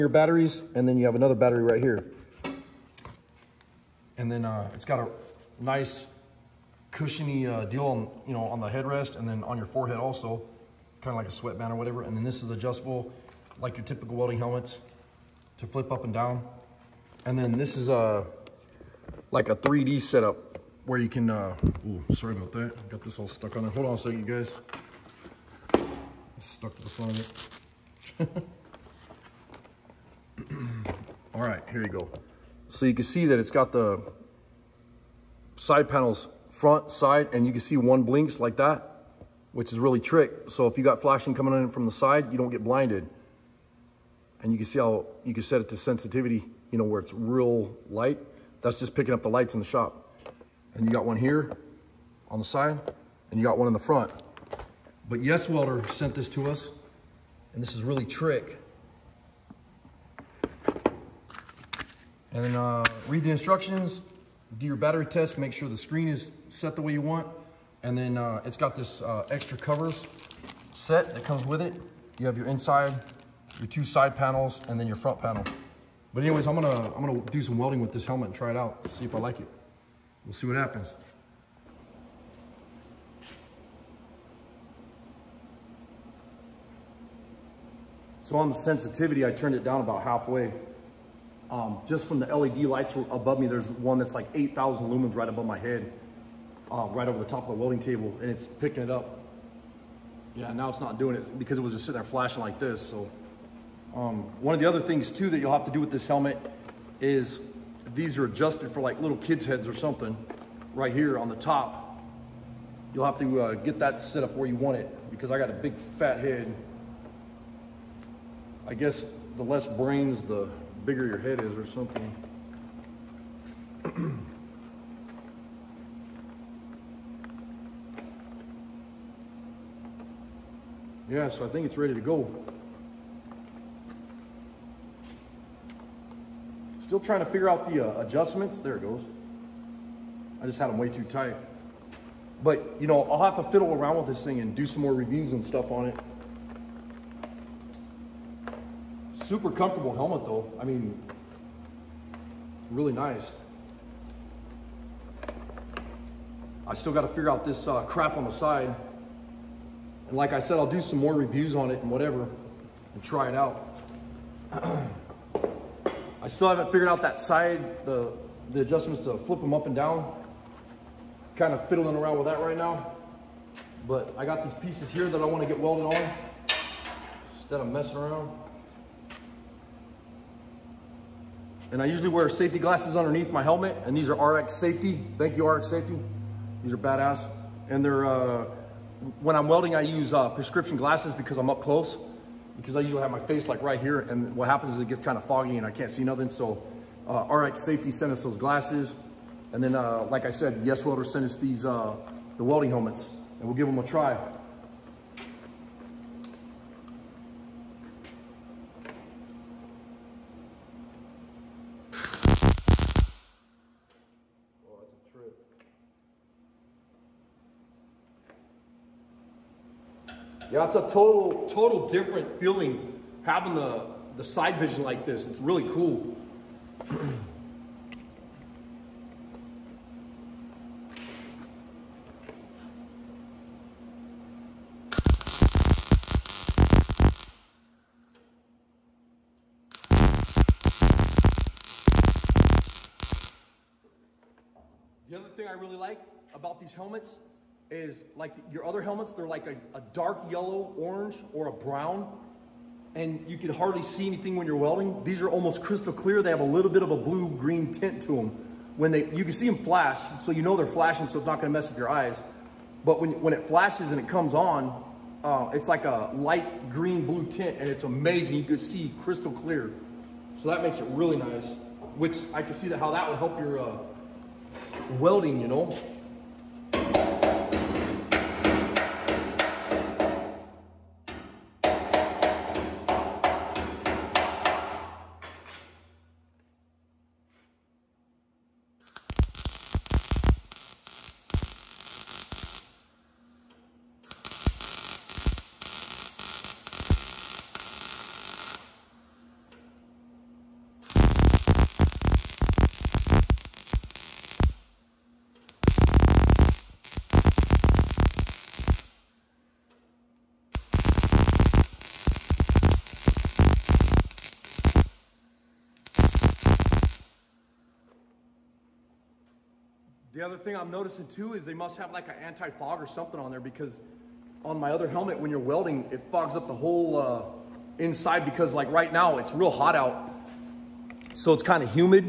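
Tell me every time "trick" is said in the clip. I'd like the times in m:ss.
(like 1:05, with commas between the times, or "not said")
0:40, 0:58.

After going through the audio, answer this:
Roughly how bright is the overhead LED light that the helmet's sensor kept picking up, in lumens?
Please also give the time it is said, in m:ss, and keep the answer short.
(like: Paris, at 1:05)
8,000, at 1:34.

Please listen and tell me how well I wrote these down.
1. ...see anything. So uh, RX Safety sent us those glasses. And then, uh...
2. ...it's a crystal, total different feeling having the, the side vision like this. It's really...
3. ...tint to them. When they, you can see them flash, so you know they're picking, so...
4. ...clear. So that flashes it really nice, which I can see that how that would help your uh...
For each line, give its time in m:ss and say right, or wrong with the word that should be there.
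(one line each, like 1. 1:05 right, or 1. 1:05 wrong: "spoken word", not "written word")
1. 3:15 wrong: "nothing", not "anything"
2. 3:40 wrong: "total", not "crystal"
3. 4:17 wrong: "flashing", not "picking"
4. 4:29 wrong: "makes", not "flashes".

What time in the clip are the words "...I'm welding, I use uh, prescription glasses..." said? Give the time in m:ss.
3:09.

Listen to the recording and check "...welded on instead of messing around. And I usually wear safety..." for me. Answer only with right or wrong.
right.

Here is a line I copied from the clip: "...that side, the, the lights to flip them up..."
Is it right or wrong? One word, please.
wrong.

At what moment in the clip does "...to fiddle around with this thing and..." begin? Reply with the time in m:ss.
2:23.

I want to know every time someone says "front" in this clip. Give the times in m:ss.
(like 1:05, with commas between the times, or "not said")
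0:26, 0:36, 0:53, 1:14.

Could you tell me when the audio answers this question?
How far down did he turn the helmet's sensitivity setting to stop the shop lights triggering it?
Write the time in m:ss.
1:29.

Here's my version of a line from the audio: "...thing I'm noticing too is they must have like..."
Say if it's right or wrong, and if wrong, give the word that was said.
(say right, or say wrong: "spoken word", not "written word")
right.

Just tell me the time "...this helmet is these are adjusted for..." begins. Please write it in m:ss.
1:45.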